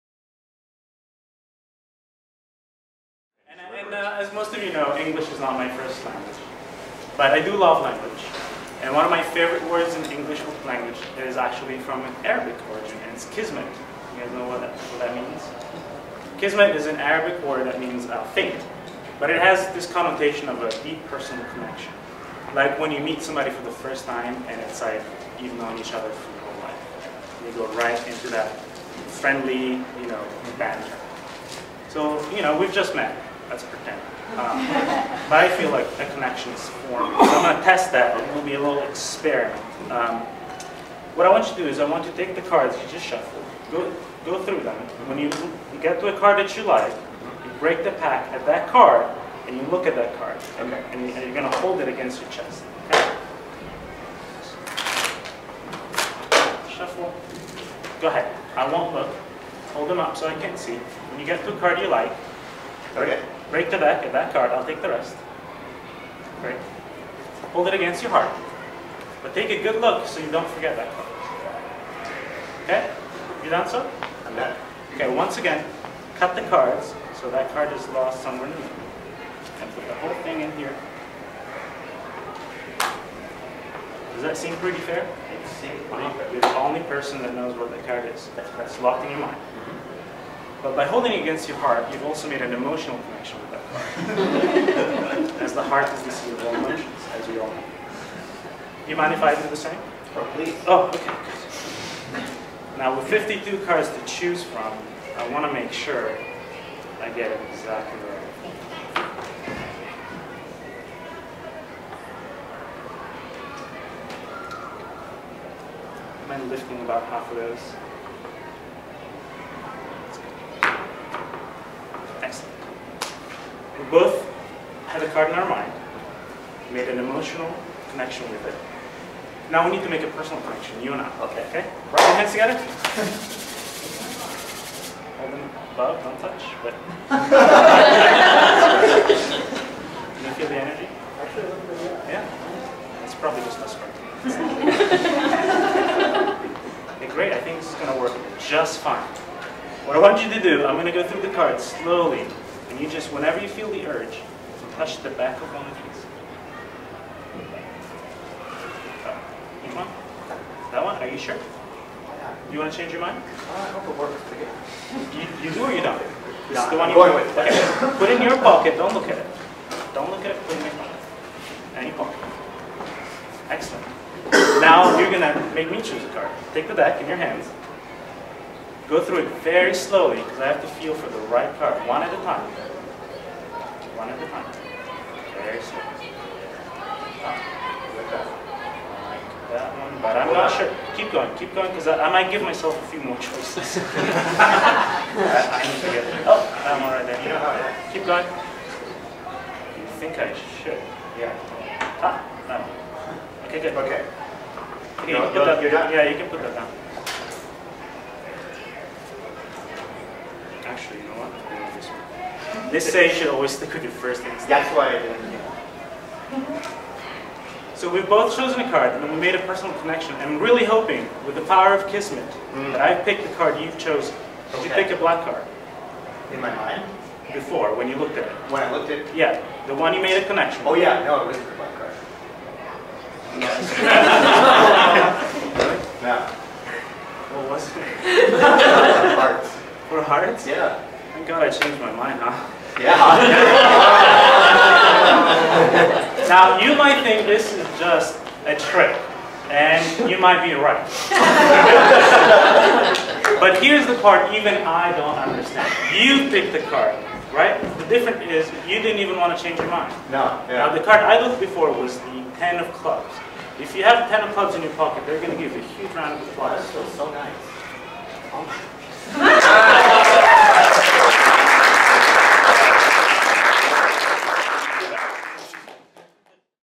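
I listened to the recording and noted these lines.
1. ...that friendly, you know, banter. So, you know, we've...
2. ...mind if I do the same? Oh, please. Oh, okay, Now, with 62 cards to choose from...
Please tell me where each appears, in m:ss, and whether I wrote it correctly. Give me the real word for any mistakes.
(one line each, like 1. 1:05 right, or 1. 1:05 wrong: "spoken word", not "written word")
1. 0:28 right
2. 1:38 wrong: "52", not "62".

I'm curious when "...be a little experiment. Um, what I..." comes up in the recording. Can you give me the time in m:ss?
0:38.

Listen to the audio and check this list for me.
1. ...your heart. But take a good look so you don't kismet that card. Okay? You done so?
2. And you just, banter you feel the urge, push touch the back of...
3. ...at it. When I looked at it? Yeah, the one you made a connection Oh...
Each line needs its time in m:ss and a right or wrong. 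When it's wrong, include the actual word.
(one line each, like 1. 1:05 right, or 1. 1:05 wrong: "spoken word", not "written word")
1. 1:08 wrong: "forget", not "kismet"
2. 2:32 wrong: "whenever", not "banter"
3. 3:48 right.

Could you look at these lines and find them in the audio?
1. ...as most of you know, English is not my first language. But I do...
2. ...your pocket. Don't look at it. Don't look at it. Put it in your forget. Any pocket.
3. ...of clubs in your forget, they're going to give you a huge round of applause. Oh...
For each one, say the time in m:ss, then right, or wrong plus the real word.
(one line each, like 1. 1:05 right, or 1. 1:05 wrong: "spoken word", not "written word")
1. 0:04 right
2. 2:48 wrong: "pocket", not "forget"
3. 4:24 wrong: "pocket", not "forget".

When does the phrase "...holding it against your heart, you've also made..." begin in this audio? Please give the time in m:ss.
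1:30.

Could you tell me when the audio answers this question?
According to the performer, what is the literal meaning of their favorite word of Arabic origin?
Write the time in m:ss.
0:18.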